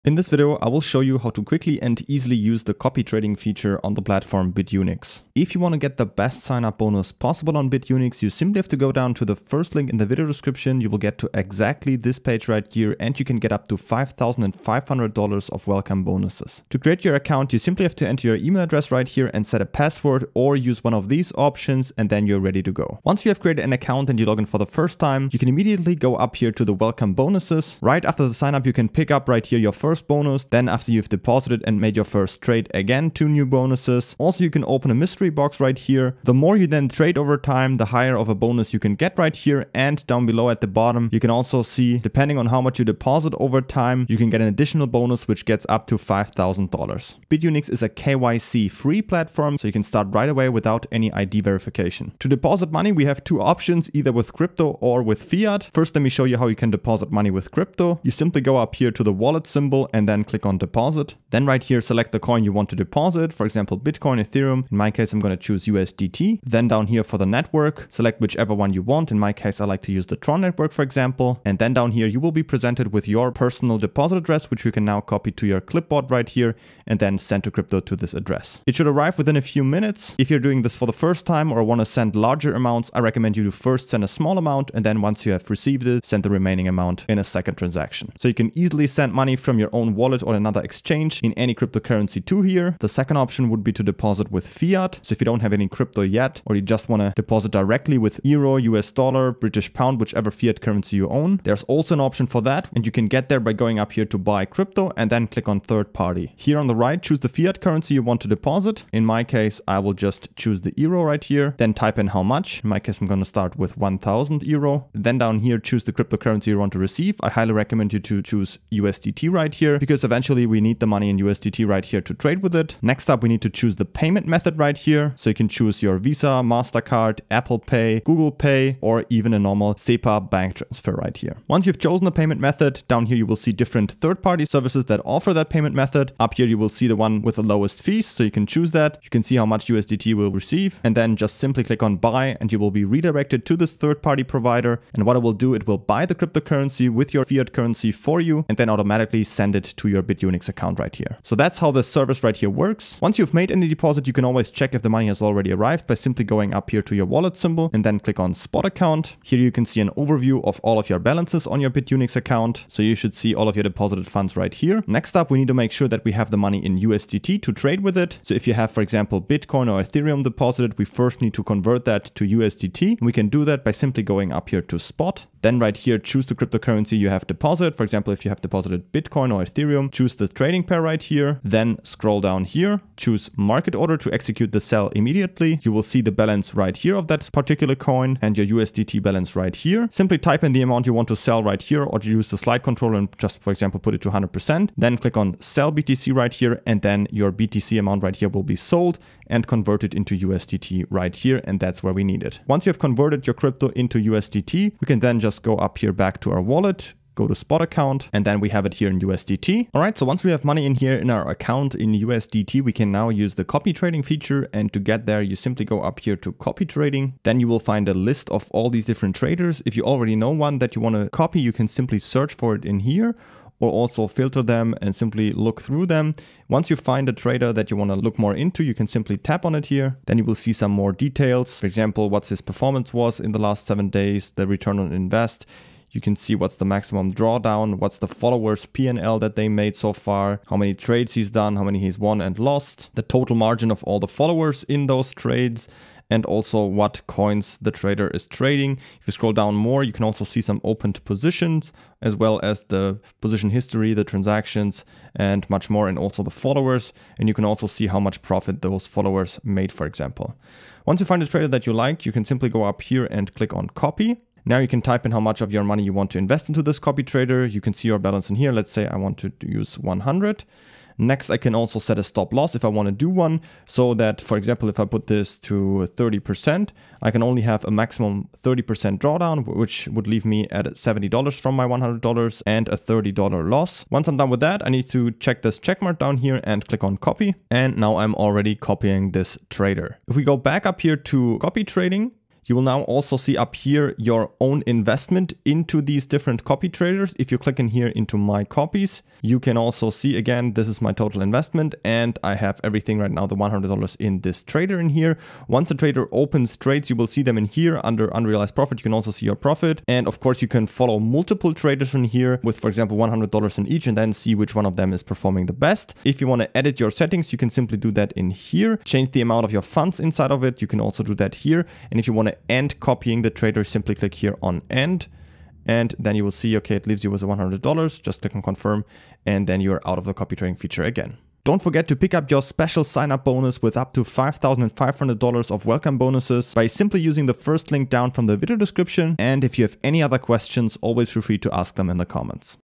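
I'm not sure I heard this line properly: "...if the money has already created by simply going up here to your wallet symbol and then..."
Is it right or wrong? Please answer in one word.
wrong.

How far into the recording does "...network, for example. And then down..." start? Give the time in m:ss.
1:10.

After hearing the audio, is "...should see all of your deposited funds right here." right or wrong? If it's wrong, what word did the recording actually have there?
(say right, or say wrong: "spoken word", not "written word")
right.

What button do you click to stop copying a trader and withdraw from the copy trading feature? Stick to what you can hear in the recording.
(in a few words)
end.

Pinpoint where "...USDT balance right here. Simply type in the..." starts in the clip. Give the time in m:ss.
3:08.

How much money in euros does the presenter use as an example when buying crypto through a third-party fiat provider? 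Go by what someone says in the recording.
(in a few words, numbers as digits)
1000 euro.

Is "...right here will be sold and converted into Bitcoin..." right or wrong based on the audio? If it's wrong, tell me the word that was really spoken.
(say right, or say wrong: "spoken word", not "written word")
wrong: "USDT", not "Bitcoin".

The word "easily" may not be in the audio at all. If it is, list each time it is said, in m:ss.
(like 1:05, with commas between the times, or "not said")
0:02, 1:28.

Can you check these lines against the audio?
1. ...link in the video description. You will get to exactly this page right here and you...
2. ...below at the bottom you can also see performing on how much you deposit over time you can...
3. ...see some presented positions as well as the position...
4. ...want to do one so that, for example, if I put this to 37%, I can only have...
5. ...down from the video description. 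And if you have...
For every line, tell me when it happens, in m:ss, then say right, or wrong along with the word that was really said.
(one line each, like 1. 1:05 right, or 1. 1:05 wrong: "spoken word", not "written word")
1. 0:09 right
2. 0:40 wrong: "depending", not "performing"
3. 4:10 wrong: "opened", not "presented"
4. 4:32 wrong: "30", not "37"
5. 5:37 right.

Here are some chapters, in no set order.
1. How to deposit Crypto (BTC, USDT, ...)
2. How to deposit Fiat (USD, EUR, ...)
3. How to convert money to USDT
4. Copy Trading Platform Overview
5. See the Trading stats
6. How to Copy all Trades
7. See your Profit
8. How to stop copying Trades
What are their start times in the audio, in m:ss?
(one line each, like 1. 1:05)
1. 0:50
2. 1:42
3. 2:45
4. 3:29
5. 3:50
6. 4:20
7. 4:50
8. 5:18.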